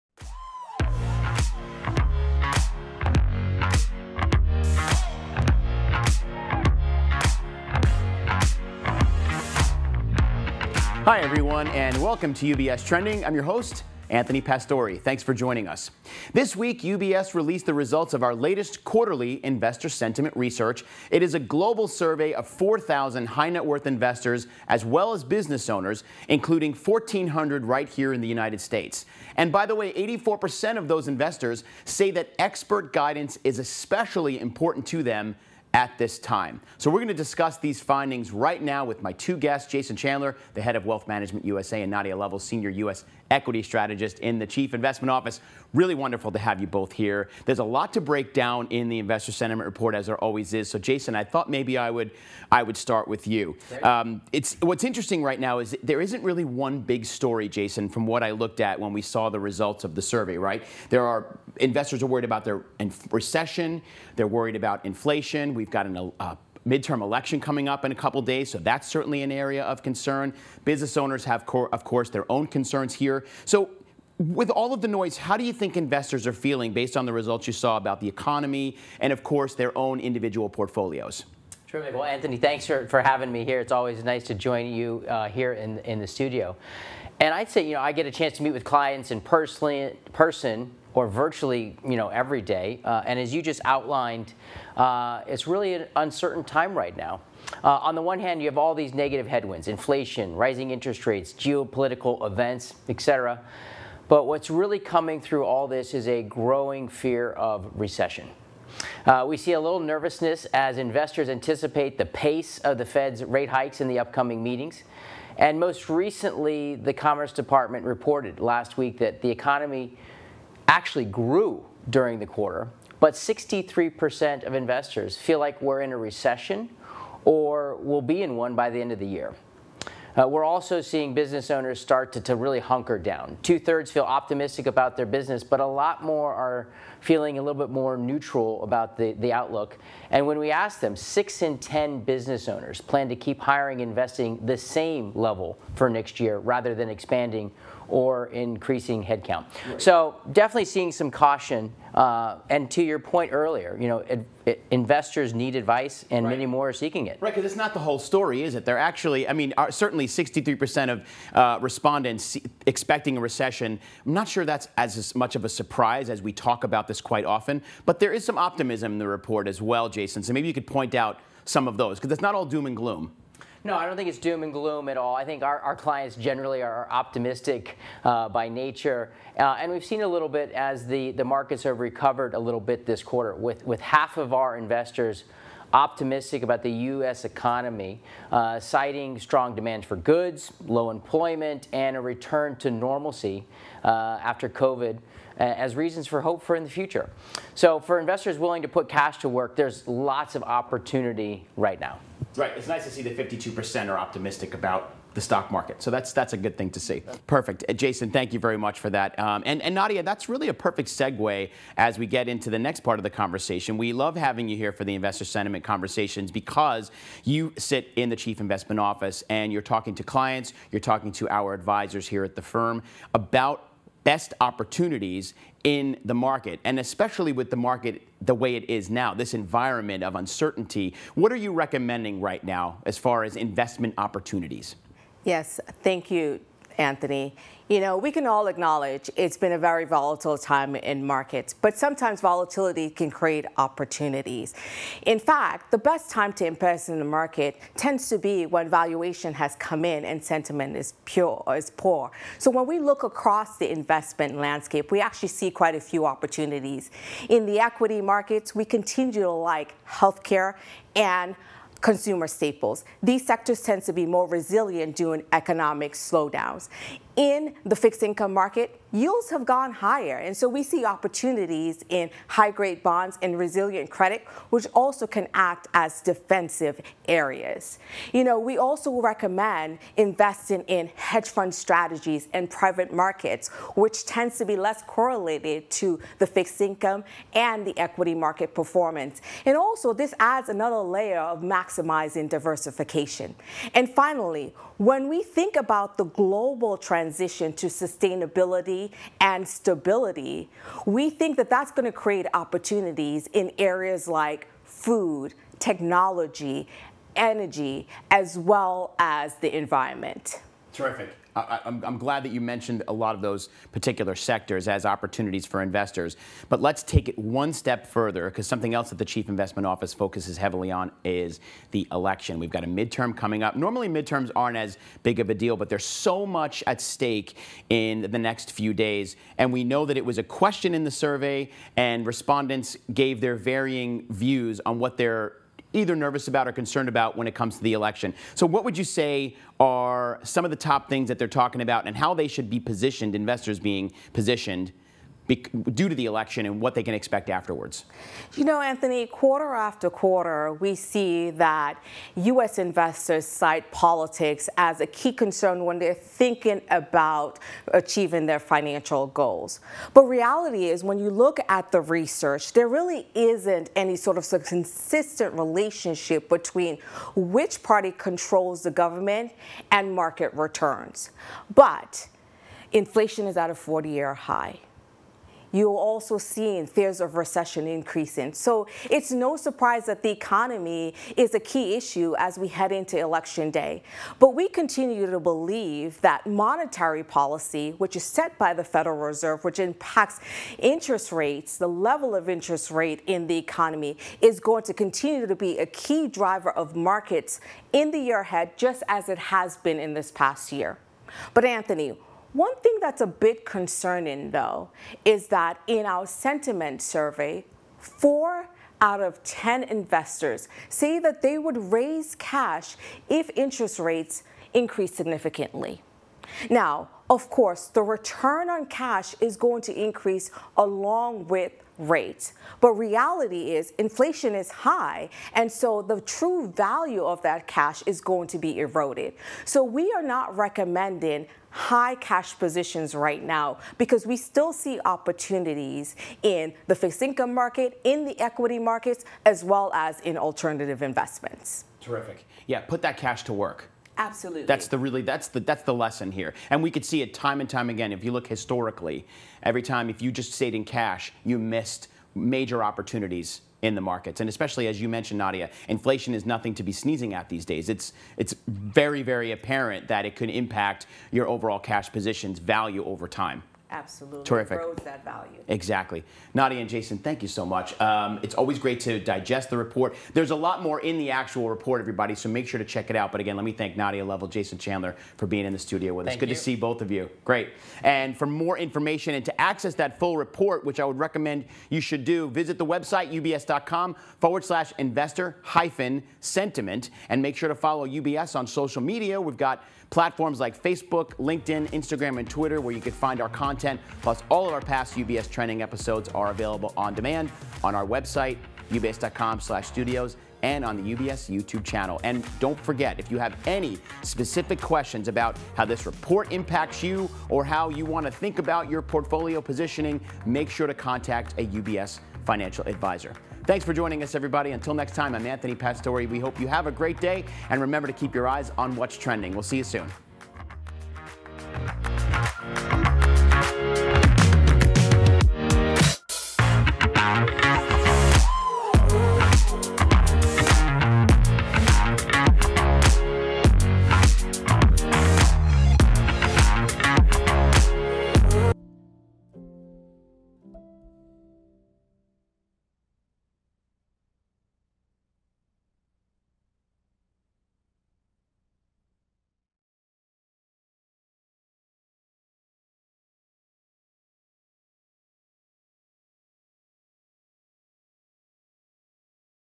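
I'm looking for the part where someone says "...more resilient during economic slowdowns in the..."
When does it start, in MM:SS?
04:24.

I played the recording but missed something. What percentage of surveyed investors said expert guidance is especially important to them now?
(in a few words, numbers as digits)
84%.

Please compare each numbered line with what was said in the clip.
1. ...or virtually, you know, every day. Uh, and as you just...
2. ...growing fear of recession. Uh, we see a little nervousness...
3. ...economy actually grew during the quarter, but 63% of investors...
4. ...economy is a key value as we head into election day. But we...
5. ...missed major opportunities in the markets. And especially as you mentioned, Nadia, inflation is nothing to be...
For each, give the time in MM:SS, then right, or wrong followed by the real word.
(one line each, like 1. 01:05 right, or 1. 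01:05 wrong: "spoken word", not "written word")
1. 01:30 right
2. 01:46 right
3. 01:59 right
4. 06:20 wrong: "issue", not "value"
5. 07:31 right.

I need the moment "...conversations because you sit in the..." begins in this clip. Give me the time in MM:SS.
03:35.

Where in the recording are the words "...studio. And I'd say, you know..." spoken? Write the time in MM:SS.
01:26.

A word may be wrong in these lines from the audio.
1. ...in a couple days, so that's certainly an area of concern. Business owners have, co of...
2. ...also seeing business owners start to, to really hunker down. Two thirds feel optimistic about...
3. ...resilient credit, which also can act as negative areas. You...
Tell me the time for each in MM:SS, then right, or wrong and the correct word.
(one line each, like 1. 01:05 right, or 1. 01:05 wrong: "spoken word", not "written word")
1. 01:07 right
2. 02:10 right
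3. 04:33 wrong: "defensive", not "negative".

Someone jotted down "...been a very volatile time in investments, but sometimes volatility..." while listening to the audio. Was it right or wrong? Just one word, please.
wrong.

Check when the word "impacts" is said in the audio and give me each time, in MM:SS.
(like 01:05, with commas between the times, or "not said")
06:29, 07:40, 08:26.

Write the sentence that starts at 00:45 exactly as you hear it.
Really wonderful to have you both here.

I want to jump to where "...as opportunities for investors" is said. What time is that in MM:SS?
05:14.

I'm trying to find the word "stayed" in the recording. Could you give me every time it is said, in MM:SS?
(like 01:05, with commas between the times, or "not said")
07:30.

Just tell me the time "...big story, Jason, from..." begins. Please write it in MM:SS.
00:56.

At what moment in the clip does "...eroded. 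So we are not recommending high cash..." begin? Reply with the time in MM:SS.
07:08.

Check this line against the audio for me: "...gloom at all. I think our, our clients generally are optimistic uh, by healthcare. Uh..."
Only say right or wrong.
wrong.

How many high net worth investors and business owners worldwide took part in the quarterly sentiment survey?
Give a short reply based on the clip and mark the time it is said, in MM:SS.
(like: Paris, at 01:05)
4,000, at 00:22.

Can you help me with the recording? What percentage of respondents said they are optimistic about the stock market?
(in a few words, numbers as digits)
52%.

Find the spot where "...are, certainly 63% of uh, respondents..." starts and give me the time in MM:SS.
02:39.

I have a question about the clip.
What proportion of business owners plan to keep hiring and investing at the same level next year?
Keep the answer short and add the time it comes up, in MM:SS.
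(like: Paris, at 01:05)
6 in 10, at 02:20.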